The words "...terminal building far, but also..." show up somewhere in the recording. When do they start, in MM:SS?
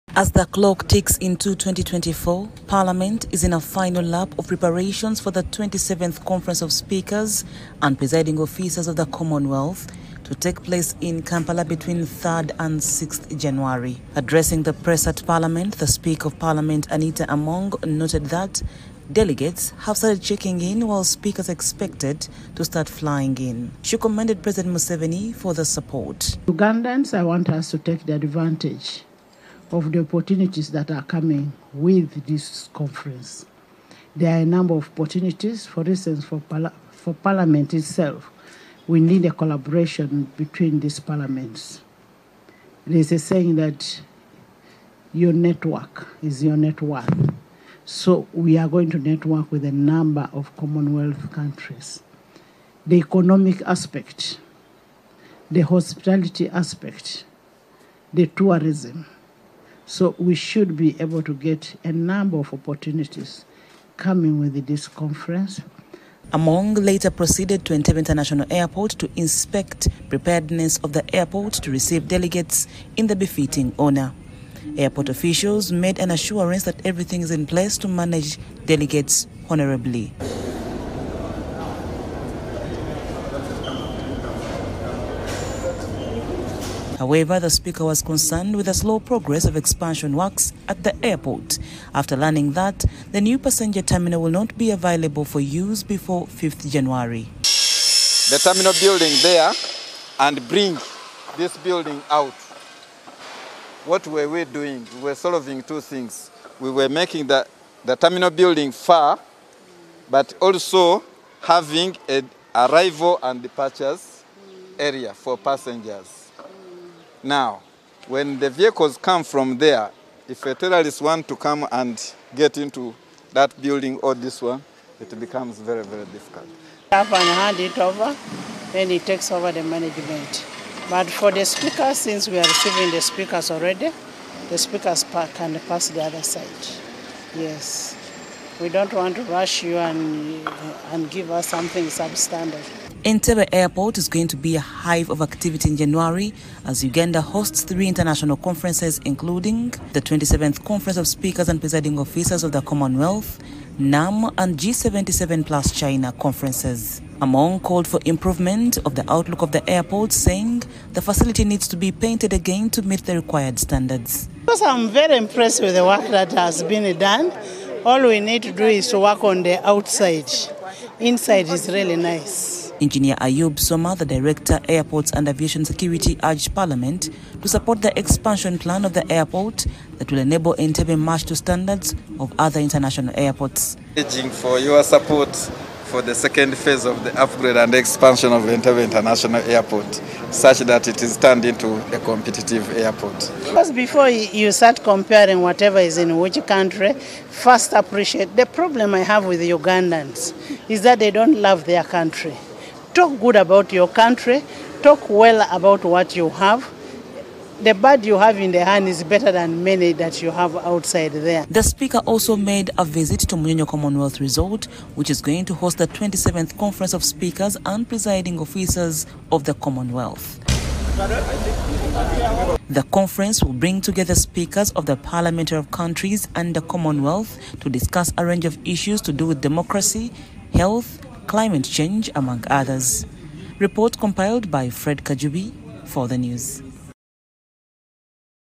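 01:47.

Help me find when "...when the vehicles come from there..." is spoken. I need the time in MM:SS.
01:58.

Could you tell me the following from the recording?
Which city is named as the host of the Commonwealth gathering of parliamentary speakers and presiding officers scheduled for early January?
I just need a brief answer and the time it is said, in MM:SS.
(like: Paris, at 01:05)
Kampala, at 00:11.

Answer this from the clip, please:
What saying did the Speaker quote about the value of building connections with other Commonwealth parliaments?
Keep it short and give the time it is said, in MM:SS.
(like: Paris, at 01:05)
Your network is your net worth, at 00:45.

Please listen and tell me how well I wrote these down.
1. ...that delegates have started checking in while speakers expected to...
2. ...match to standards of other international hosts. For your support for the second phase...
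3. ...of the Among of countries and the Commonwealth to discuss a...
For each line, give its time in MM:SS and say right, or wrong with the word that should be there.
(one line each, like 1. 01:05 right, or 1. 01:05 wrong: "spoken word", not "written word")
1. 00:18 right
2. 03:00 wrong: "airports", not "hosts"
3. 03:44 wrong: "Parliament", not "Among".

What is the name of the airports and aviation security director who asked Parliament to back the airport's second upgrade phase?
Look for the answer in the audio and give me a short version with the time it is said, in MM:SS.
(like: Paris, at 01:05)
Ayub Soma, at 02:53.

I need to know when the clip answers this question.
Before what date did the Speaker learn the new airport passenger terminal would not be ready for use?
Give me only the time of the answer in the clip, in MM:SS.
01:36.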